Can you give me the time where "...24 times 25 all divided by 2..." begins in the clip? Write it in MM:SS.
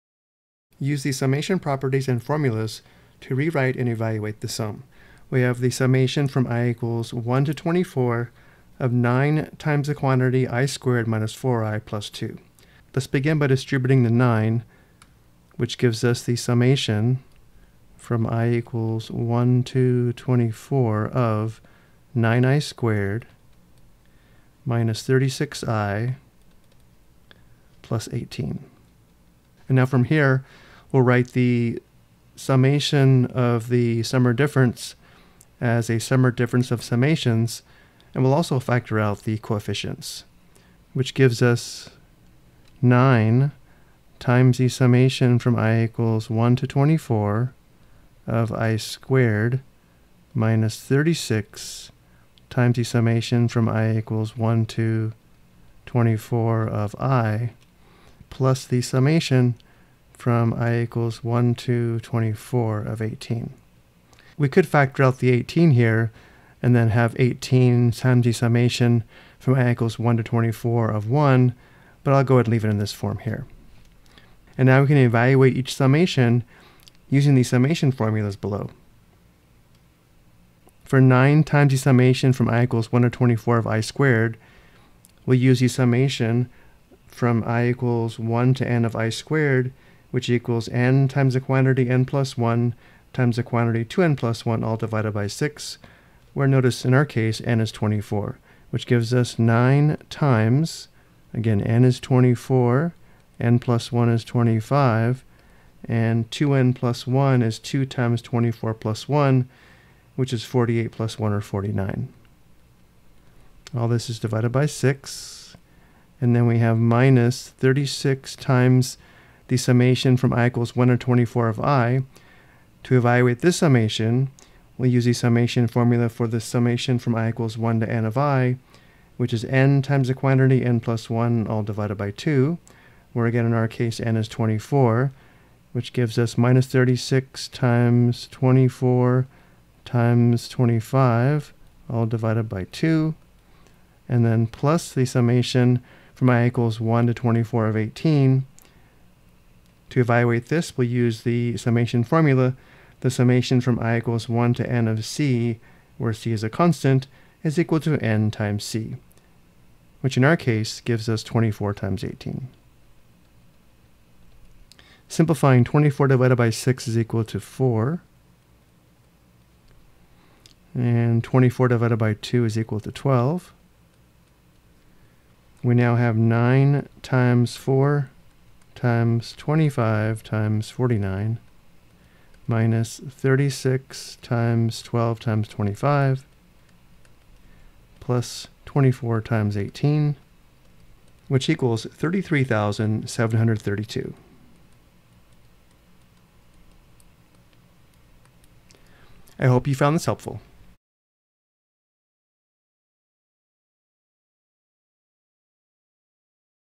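02:18.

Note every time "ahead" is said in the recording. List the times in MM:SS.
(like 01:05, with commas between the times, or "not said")
01:12.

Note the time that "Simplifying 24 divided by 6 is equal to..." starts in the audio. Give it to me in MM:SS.
02:45.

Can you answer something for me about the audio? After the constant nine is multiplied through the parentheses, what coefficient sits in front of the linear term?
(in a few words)
36.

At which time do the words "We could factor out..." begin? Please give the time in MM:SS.
01:04.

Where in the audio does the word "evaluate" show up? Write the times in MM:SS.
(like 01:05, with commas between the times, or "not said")
00:03, 01:14, 02:02, 02:29.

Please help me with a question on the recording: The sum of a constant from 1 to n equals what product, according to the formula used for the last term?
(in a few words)
n times c.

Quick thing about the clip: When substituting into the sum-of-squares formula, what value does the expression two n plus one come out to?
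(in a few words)
49.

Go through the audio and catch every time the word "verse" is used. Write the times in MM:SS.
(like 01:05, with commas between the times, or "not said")
not said.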